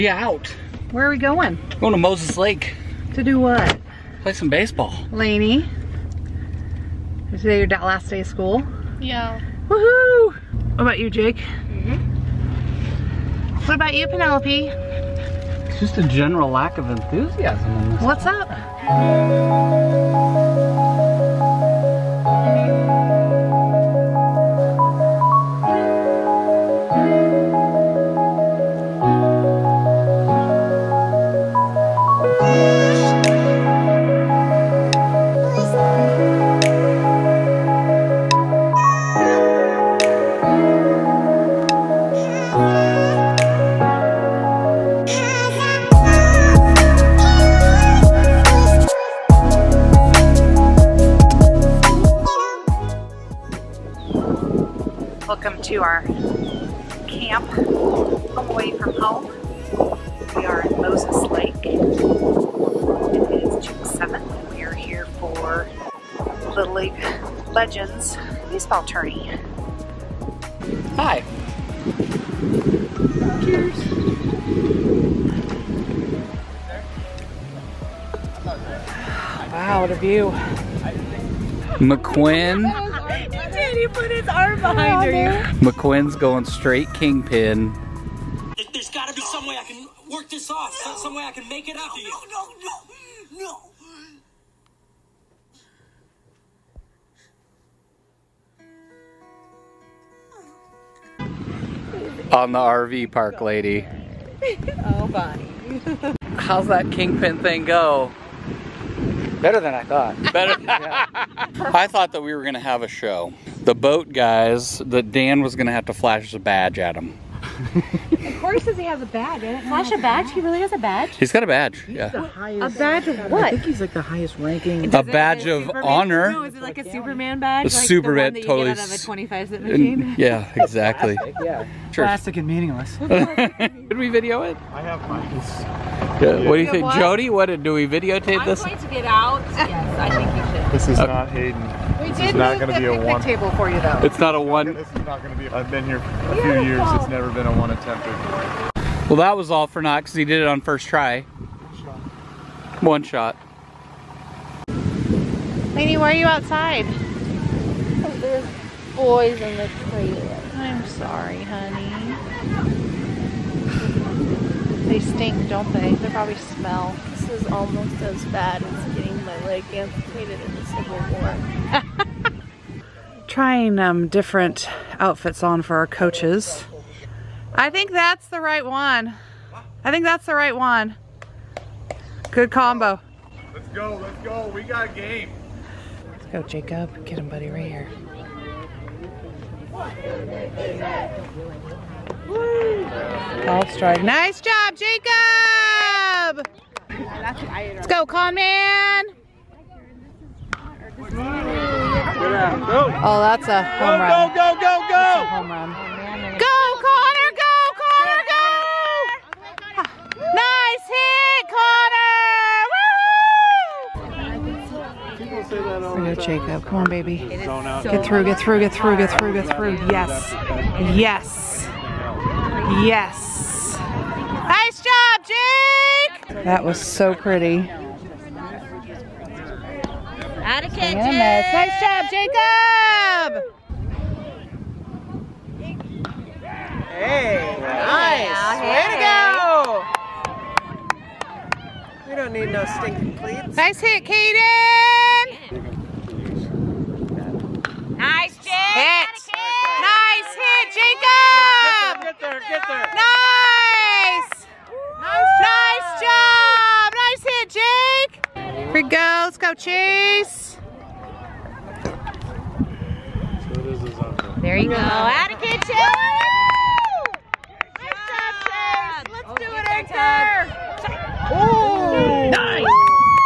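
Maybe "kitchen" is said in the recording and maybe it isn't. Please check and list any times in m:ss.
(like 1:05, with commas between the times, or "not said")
3:50, 4:25.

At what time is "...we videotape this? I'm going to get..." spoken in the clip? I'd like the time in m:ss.
2:17.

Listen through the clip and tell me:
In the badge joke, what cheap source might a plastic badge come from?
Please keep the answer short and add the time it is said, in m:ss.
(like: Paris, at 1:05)
25 cent machine, at 2:09.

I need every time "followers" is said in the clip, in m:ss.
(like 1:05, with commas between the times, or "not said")
not said.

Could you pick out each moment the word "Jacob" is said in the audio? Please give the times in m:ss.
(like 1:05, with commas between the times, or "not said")
3:06, 3:14, 3:36, 3:52, 4:10.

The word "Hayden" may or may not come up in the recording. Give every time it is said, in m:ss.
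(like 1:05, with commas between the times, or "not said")
2:21.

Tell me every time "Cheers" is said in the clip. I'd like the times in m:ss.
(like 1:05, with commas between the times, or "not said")
1:13.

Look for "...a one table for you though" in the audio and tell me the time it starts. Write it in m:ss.
2:22.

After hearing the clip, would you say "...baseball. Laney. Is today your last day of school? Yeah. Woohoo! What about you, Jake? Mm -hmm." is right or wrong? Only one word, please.
right.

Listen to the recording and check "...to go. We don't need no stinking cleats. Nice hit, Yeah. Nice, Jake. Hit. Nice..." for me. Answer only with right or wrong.
wrong.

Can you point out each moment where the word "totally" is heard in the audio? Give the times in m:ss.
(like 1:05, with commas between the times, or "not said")
2:08.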